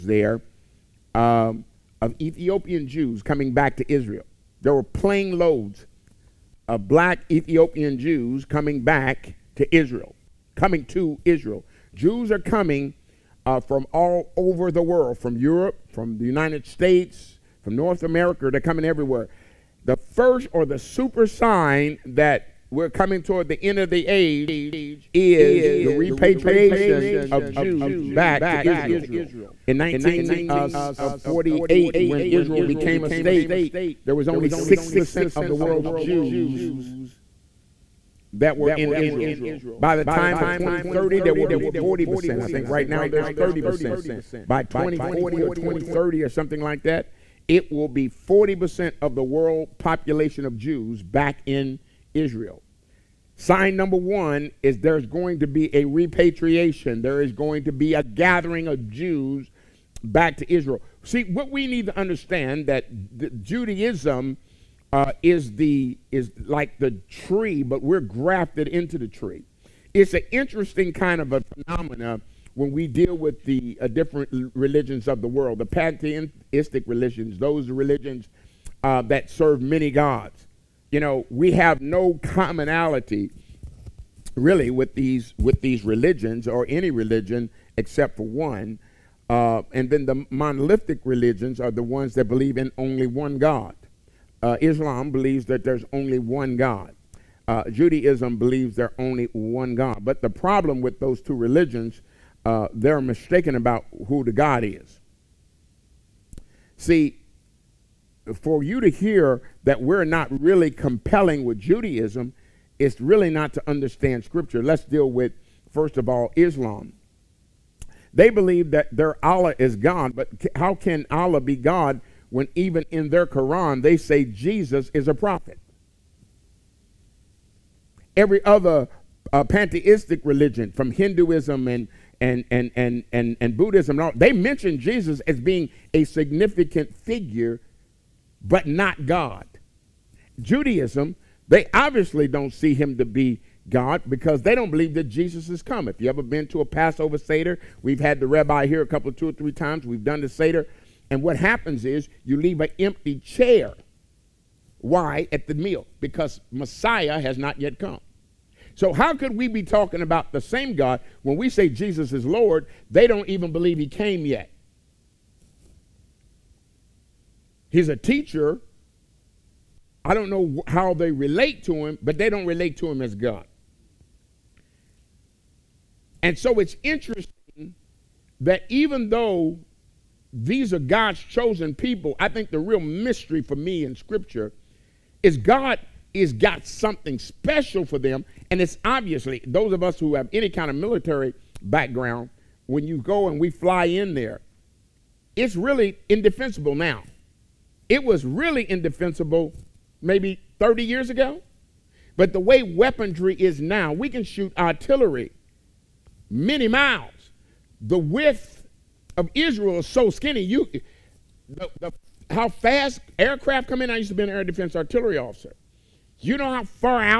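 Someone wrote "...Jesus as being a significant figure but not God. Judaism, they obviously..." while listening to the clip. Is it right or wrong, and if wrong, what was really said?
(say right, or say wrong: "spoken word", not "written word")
right.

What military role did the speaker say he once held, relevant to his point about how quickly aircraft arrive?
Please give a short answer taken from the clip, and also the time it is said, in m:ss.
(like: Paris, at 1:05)
Air defense artillery officer, at 3:34.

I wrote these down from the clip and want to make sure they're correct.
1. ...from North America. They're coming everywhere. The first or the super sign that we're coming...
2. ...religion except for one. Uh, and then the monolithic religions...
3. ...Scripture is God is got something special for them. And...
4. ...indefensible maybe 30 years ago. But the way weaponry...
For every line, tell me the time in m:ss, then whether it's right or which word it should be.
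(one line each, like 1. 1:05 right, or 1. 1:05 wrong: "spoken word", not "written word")
1. 0:17 right
2. 1:26 right
3. 3:03 right
4. 3:18 right.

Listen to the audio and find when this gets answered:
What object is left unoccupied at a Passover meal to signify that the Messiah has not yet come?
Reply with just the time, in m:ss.
2:32.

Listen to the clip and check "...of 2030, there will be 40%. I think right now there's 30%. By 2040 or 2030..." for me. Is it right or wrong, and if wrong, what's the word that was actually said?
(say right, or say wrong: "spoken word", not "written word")
right.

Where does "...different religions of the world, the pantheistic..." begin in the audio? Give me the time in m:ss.
1:13.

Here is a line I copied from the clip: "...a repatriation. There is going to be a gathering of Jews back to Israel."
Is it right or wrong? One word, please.
right.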